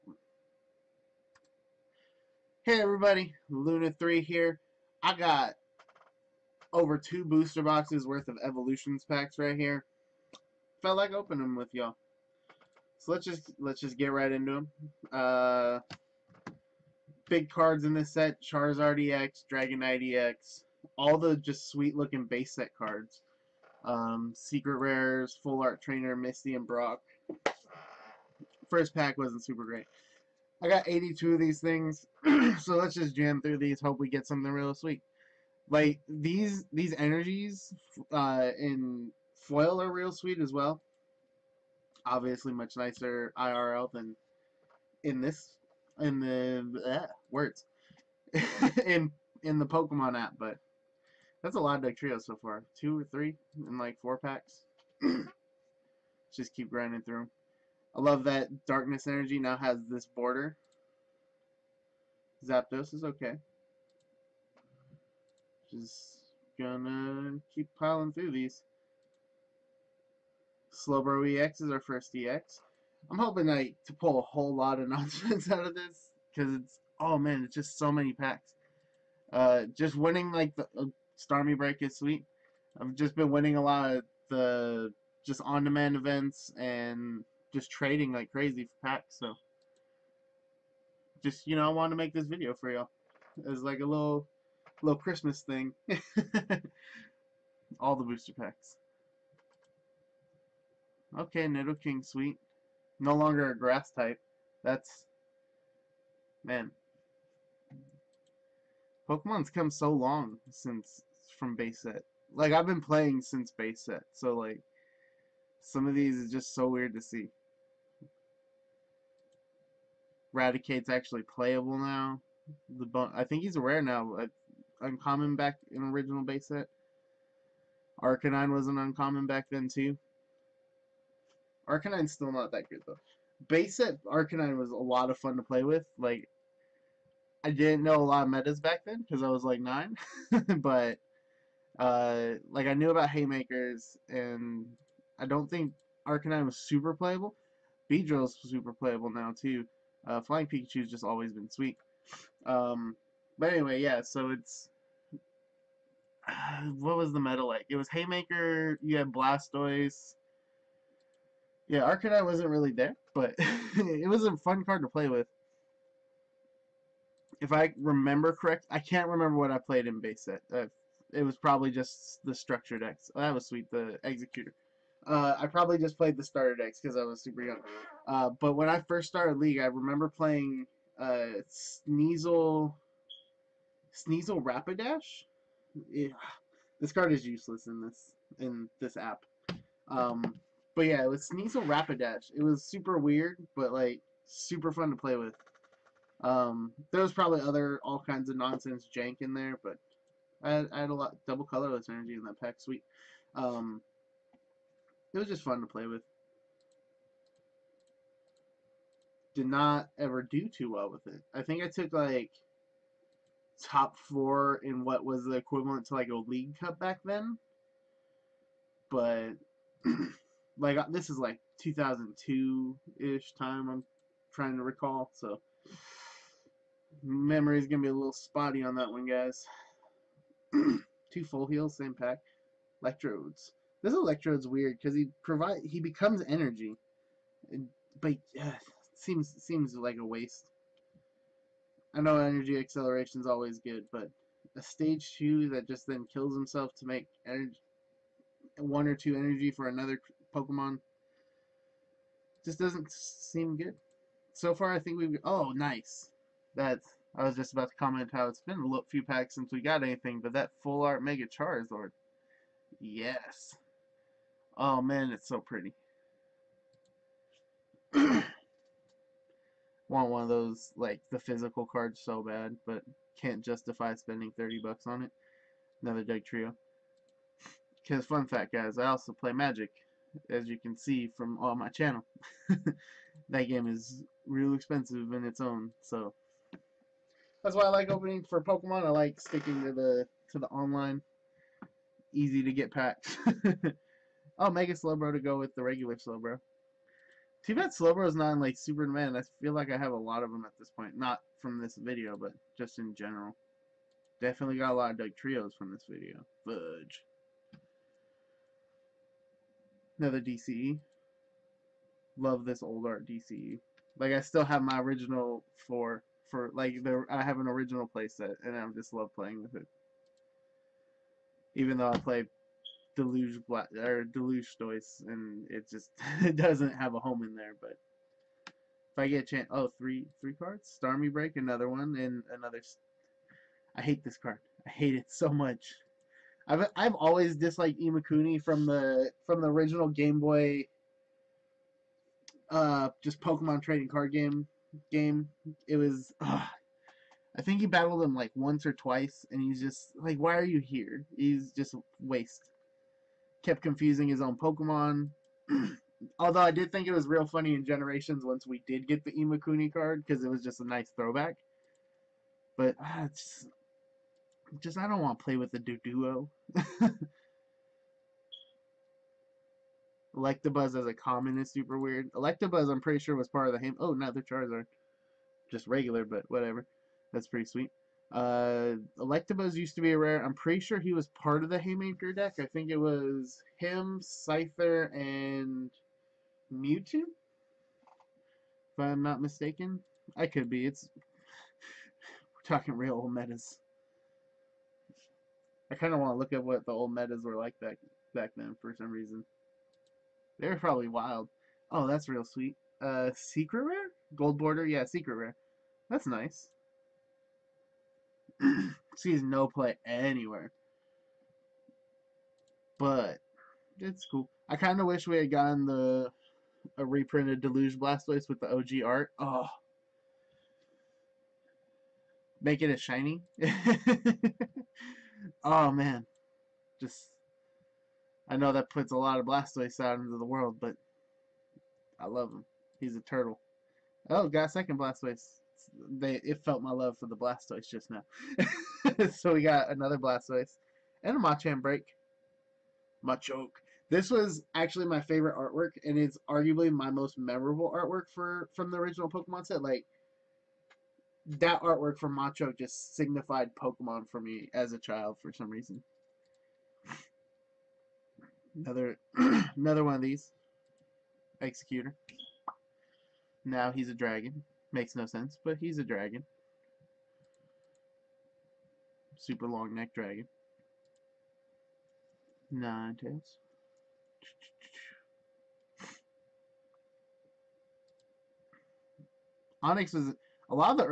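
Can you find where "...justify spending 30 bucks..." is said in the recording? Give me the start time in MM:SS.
04:33.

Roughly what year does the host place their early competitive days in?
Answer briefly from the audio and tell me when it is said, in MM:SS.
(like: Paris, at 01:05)
2002, at 03:41.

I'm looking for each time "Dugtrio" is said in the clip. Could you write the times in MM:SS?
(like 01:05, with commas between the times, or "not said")
04:36, 05:04.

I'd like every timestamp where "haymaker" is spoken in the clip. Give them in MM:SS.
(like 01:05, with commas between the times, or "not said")
02:23, 02:37, 06:21.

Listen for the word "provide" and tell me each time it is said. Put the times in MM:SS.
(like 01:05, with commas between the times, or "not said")
03:55.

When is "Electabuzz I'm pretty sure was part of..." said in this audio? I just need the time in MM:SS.
06:12.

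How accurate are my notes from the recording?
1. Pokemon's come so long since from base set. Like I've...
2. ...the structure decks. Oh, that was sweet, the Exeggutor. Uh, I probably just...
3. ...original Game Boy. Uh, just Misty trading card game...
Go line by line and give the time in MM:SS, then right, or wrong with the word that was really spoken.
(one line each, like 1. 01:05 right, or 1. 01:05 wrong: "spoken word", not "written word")
1. 01:49 right
2. 02:52 right
3. 05:39 wrong: "Pokemon", not "Misty".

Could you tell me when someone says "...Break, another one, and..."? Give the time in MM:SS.
05:31.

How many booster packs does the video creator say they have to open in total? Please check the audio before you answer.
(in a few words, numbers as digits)
82.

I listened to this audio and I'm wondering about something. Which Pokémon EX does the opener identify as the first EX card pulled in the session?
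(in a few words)
Slowbro EX.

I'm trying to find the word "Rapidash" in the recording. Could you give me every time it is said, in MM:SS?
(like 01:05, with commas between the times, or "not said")
03:04, 03:11.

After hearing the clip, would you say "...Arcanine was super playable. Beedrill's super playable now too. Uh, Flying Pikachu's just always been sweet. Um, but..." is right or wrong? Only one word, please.
right.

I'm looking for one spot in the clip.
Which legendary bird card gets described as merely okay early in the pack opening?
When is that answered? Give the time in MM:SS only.
01:02.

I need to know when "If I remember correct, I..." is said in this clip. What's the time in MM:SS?
02:47.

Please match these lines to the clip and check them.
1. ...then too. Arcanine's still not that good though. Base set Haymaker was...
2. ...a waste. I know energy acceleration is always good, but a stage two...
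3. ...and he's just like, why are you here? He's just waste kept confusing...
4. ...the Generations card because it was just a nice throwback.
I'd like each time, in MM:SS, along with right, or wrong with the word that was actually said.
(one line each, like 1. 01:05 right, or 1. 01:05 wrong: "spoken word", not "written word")
1. 02:09 wrong: "Arcanine", not "Haymaker"
2. 03:59 right
3. 05:49 right
4. 05:59 wrong: "Imakuni", not "Generations".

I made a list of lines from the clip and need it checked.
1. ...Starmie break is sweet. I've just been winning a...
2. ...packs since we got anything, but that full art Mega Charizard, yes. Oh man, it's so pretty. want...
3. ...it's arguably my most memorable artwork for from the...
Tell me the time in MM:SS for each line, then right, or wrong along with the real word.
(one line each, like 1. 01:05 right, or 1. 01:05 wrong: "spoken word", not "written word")
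1. 01:21 right
2. 04:19 right
3. 07:25 right.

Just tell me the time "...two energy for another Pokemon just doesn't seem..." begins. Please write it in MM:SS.
04:08.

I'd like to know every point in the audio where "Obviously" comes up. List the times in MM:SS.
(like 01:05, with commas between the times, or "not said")
00:42.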